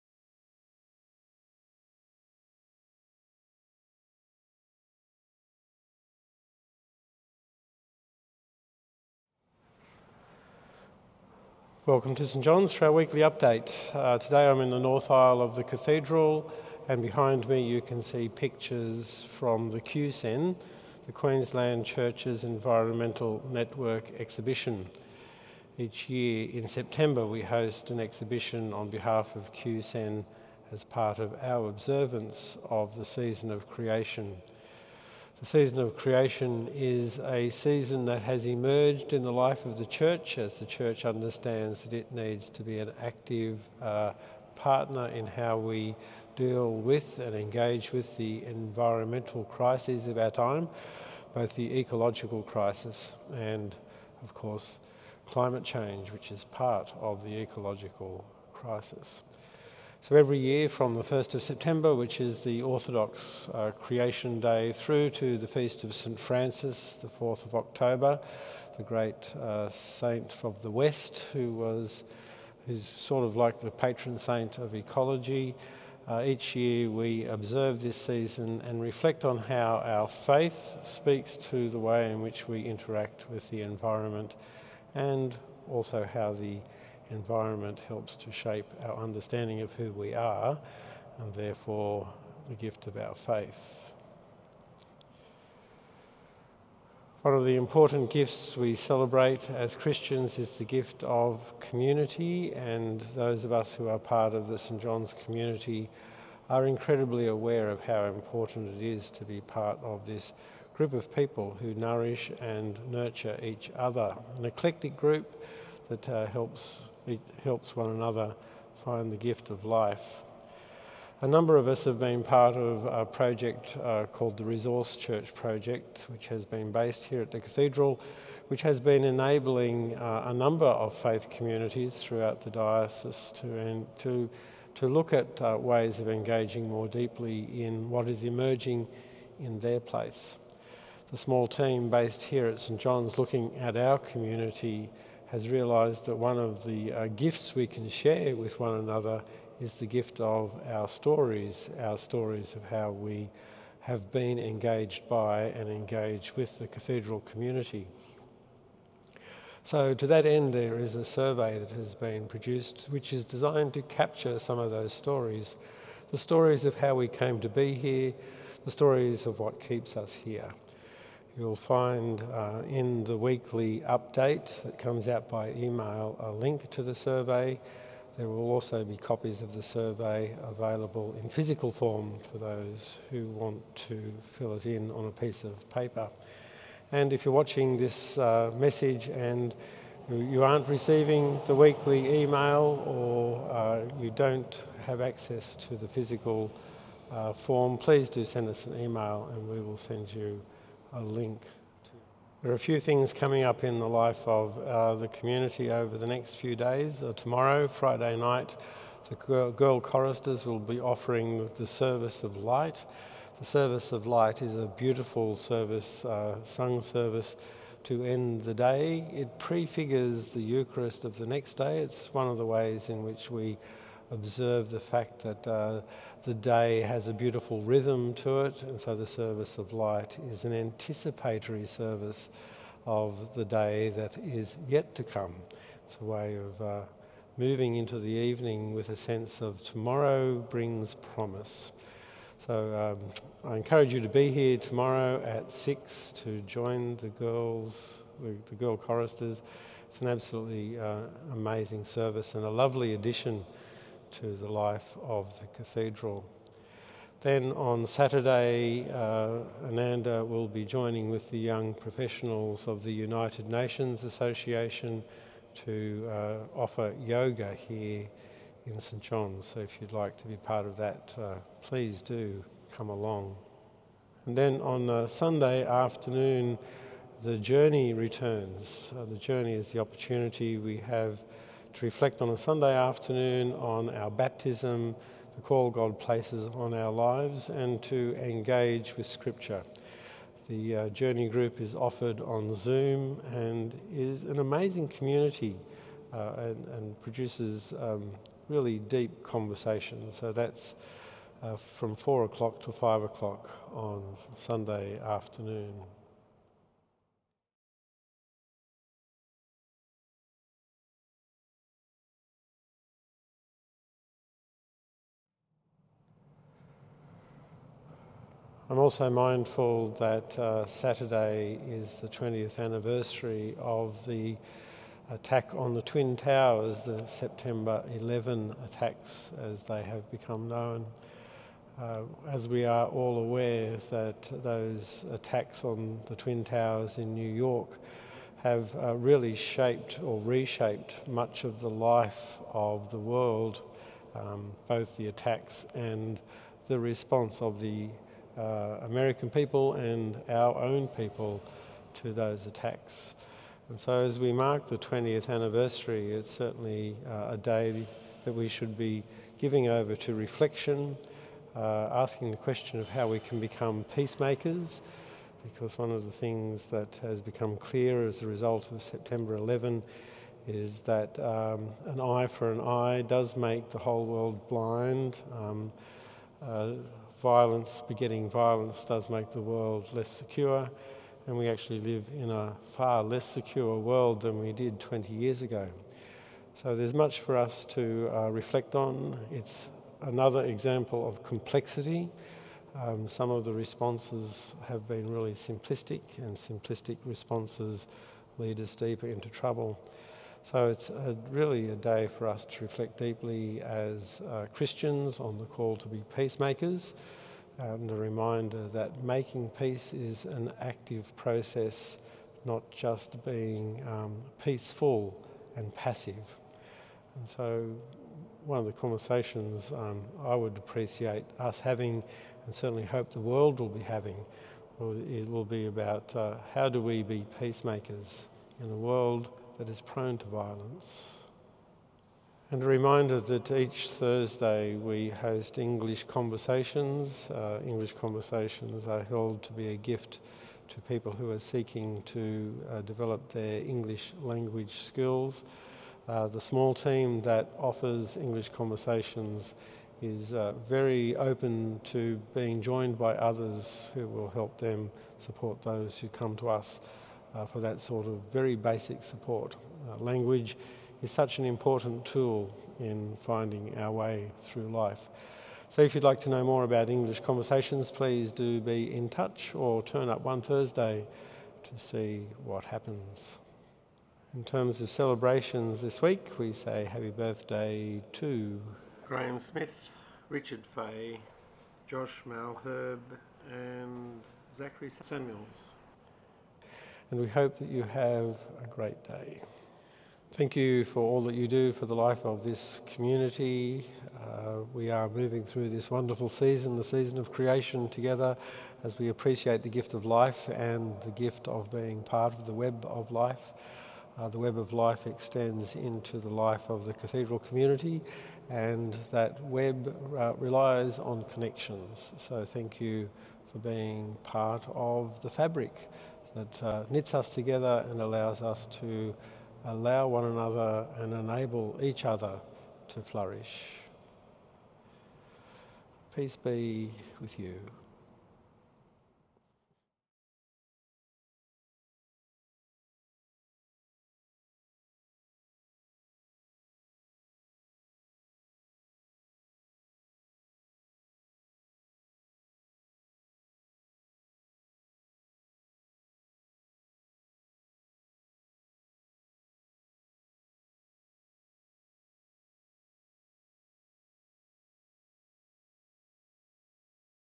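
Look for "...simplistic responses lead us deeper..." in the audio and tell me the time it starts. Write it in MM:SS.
06:36.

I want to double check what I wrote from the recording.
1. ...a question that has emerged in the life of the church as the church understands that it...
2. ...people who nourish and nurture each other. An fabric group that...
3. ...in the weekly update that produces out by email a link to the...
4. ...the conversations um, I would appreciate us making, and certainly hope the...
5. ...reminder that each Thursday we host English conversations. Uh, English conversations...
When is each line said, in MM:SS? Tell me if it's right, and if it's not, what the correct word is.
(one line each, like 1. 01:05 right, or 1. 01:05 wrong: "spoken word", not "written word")
1. 00:37 wrong: "season", not "question"
2. 01:51 wrong: "eclectic", not "fabric"
3. 02:52 wrong: "comes", not "produces"
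4. 06:58 wrong: "having", not "making"
5. 07:12 right.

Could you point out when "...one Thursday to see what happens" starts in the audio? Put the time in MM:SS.
07:50.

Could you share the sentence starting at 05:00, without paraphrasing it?
So that's uh, from four o'clock to five o'clock on Sunday afternoon.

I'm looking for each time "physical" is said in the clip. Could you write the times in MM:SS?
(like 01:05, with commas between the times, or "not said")
03:01, 03:15.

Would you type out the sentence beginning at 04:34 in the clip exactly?
And then on uh, Sunday afternoon, the journey returns.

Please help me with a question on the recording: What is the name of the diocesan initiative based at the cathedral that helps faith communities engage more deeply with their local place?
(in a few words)
Resource Church Project.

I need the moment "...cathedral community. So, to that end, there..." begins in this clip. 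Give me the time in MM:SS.
02:36.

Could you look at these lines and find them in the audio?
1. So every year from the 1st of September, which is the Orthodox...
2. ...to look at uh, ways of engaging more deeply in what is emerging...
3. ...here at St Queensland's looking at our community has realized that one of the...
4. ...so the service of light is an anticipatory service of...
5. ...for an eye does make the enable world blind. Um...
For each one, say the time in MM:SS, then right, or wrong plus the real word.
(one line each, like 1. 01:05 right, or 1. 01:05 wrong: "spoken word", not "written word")
1. 01:00 right
2. 02:14 right
3. 02:22 wrong: "John", not "Queensland"
4. 03:48 right
5. 06:12 wrong: "whole", not "enable".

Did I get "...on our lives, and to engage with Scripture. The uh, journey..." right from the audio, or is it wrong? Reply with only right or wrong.
right.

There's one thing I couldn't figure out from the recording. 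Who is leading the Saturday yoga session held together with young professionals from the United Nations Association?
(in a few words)
Ananda.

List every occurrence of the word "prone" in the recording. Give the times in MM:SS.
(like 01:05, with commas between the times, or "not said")
07:09.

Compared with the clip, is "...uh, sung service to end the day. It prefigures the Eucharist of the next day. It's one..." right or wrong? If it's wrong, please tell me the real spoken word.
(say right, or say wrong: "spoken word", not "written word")
right.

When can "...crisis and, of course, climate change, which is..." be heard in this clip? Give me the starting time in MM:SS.
00:52.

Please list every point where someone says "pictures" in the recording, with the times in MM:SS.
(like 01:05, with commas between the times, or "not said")
00:18.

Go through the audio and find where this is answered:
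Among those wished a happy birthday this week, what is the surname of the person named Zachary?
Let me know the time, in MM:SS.
08:04.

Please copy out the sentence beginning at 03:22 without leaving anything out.
There are a few things coming up in the life of uh, the community over the next few days.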